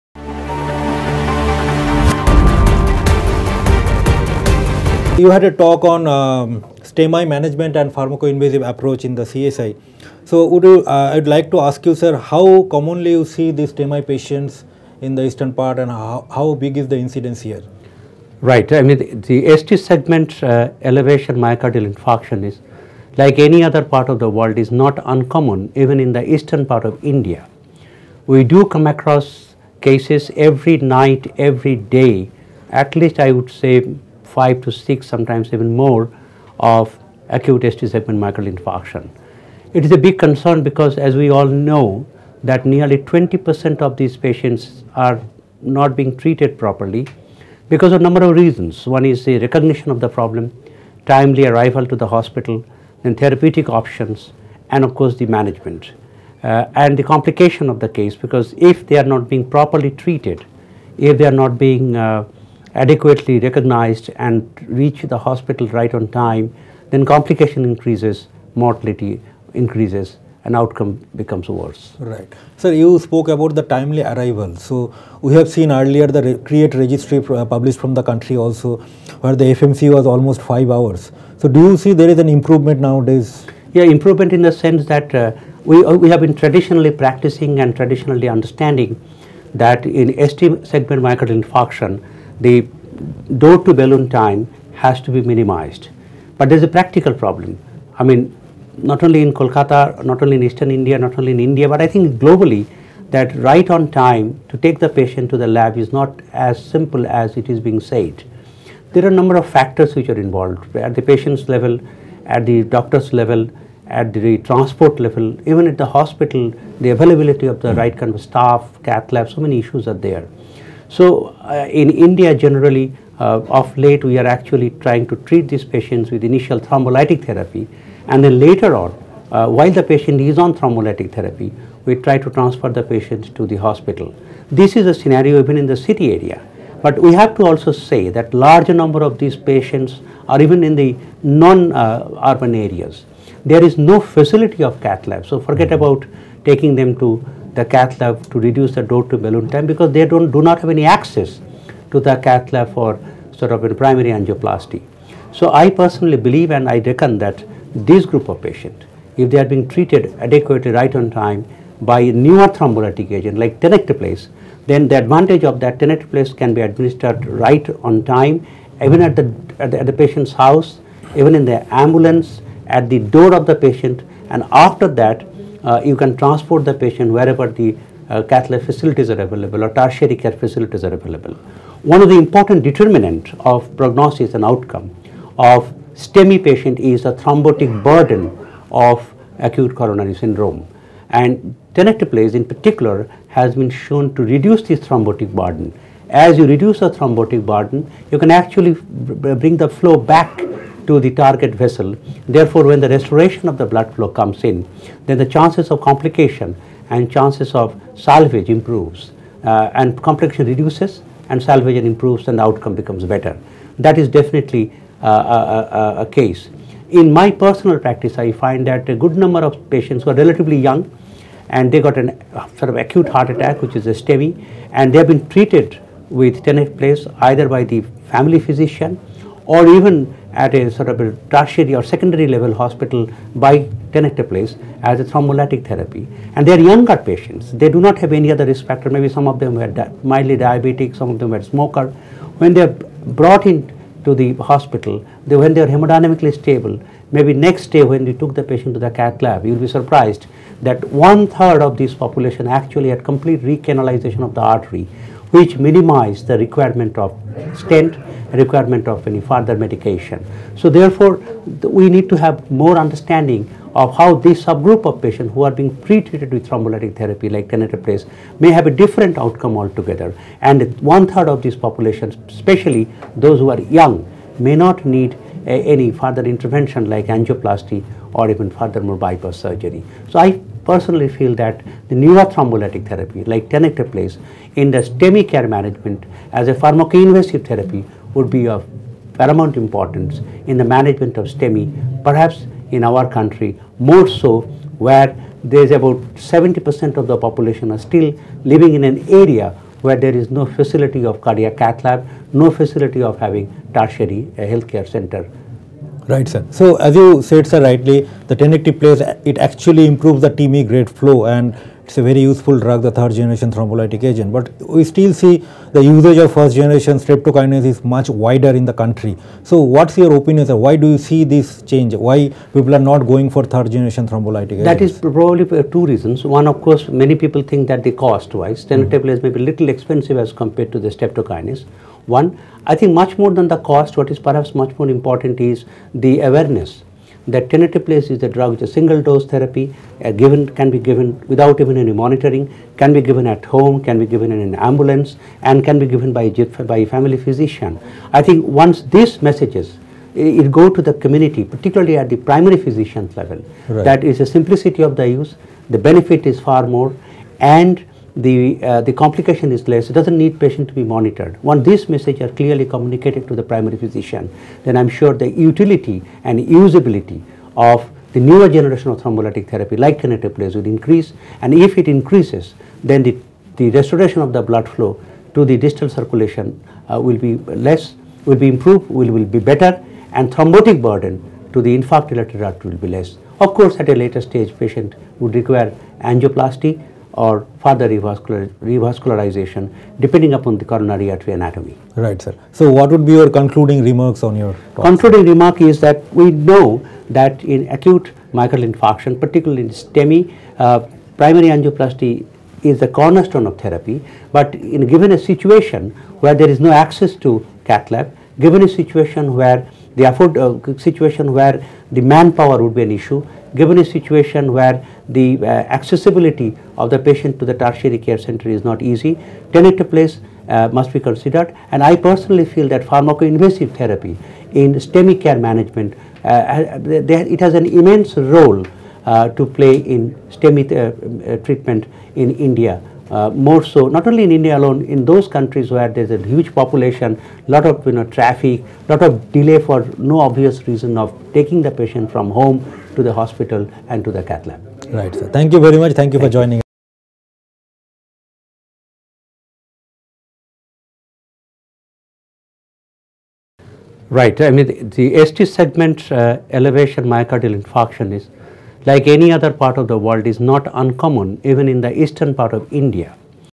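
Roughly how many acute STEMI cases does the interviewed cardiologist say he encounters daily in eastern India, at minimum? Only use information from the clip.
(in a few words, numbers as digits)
5 to 6.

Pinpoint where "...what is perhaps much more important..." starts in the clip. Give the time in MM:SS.
05:33.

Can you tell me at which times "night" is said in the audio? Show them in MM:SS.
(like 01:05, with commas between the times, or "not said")
00:30.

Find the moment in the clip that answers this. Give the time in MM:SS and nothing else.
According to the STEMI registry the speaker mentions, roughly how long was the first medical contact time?
01:20.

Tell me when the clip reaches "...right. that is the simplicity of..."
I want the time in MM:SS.
05:53.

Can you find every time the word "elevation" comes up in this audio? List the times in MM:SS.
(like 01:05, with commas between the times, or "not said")
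00:20, 07:36.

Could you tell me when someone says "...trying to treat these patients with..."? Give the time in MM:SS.
02:04.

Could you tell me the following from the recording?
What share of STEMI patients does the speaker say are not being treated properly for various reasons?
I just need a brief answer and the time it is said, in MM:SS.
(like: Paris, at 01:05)
20%, at 00:42.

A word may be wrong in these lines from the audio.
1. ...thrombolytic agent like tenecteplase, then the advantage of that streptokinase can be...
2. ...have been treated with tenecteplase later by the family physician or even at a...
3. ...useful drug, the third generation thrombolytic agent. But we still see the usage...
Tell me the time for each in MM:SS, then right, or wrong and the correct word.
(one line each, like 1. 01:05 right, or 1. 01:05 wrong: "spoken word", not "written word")
1. 02:42 wrong: "tenecteplase", not "streptokinase"
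2. 03:44 wrong: "either", not "later"
3. 05:12 right.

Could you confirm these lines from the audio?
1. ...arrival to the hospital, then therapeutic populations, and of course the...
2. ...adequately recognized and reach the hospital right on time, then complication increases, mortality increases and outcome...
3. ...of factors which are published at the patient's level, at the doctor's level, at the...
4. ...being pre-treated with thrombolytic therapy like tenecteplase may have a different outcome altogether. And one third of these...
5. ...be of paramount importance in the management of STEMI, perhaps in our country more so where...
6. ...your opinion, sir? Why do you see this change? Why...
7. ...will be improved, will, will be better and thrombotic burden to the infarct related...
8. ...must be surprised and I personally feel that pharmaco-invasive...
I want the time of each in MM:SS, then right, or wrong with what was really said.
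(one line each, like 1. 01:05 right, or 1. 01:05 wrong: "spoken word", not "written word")
1. 00:51 wrong: "options", not "populations"
2. 01:02 right
3. 01:49 wrong: "involved", not "published"
4. 04:25 right
5. 04:48 right
6. 05:19 right
7. 06:18 right
8. 07:00 wrong: "considered", not "surprised".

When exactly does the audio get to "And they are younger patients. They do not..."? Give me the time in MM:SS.
03:56.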